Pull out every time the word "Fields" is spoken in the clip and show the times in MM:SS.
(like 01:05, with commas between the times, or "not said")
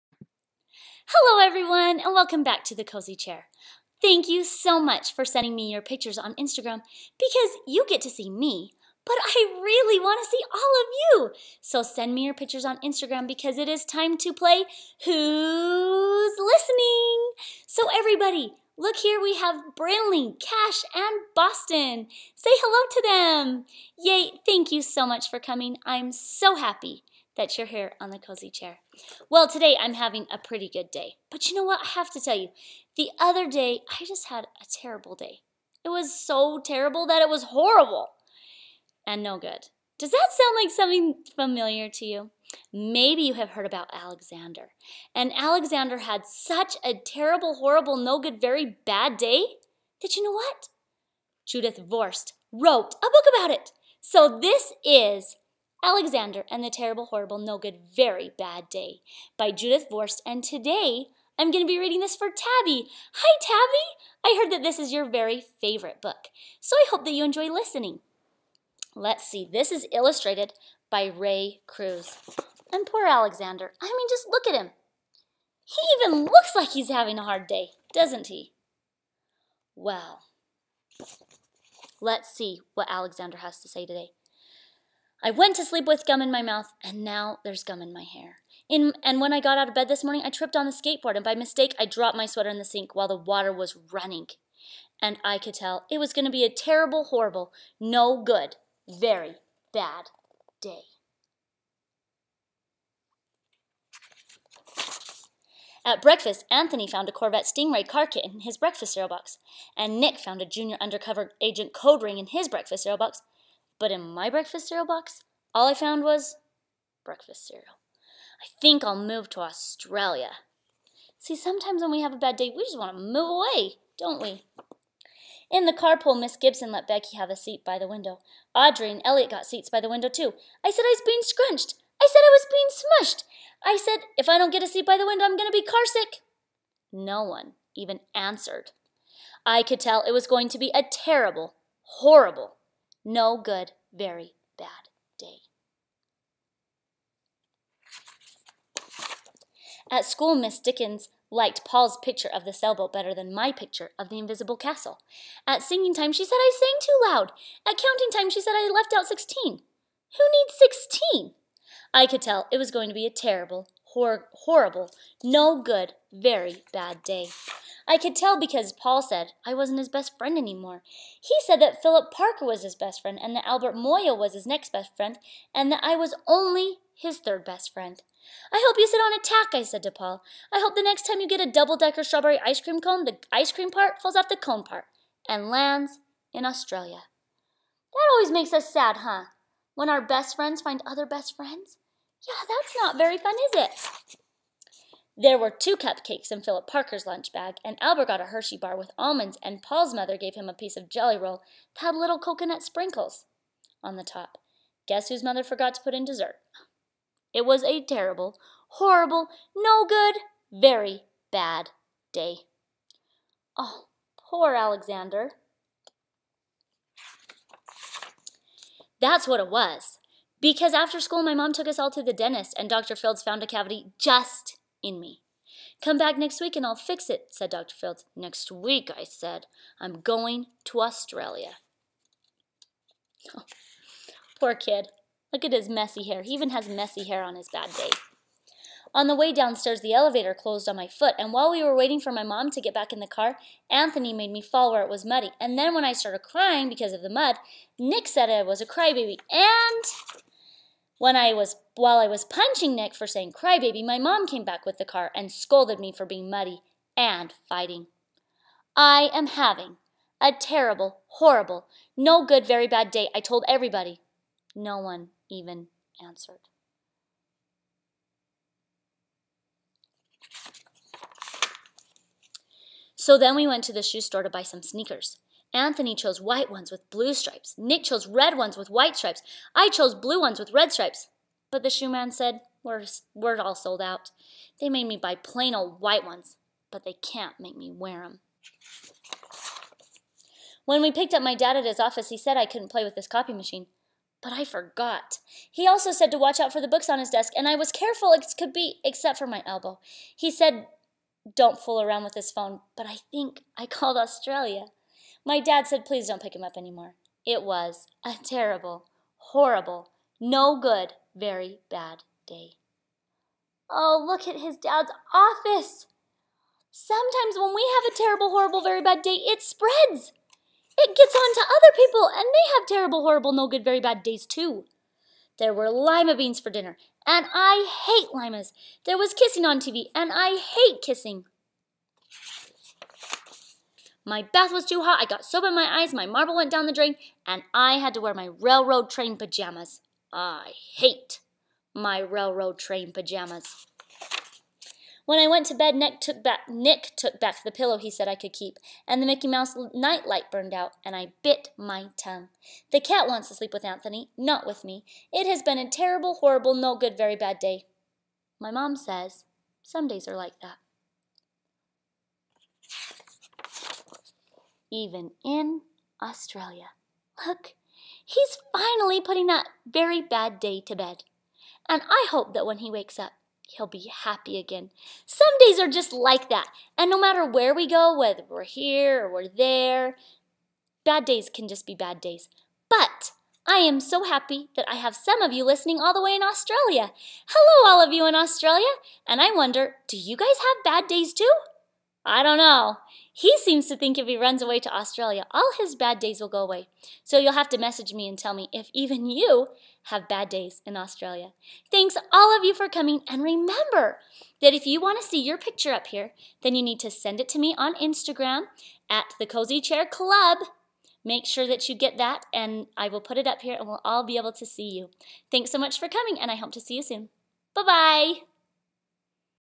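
03:42, 03:47.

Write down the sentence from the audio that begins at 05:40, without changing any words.
I hate my railroad train pajamas.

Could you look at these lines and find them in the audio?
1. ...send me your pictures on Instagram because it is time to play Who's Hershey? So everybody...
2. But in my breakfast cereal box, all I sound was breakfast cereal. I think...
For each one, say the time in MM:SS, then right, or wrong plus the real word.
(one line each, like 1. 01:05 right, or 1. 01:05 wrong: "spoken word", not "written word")
1. 00:11 wrong: "Listening", not "Hershey"
2. 01:53 wrong: "found", not "sound".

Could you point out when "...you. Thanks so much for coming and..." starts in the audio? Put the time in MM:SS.
06:54.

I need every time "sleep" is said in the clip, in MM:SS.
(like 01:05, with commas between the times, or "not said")
01:25, 05:53.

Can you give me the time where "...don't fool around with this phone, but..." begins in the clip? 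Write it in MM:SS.
05:01.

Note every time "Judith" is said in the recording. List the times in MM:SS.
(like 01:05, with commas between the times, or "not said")
00:51, 00:59.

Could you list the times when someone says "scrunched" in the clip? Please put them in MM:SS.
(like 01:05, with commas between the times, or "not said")
02:11.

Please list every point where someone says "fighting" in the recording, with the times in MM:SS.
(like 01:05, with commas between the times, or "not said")
04:17.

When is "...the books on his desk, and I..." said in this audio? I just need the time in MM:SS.
04:56.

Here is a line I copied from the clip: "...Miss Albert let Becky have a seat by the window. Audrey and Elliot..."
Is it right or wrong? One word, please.
wrong.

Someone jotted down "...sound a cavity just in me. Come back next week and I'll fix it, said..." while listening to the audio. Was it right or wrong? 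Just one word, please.
wrong.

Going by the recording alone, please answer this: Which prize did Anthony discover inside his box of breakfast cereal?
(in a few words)
Corvette Stingray car kit.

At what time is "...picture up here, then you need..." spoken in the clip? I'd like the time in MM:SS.
06:45.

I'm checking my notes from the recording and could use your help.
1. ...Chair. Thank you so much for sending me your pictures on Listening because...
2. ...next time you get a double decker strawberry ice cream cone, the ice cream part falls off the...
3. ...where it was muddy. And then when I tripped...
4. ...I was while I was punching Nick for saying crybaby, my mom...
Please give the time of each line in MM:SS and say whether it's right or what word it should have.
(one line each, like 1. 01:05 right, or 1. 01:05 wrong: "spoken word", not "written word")
1. 00:03 wrong: "Instagram", not "Listening"
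2. 03:00 right
3. 04:04 wrong: "started", not "tripped"
4. 04:11 right.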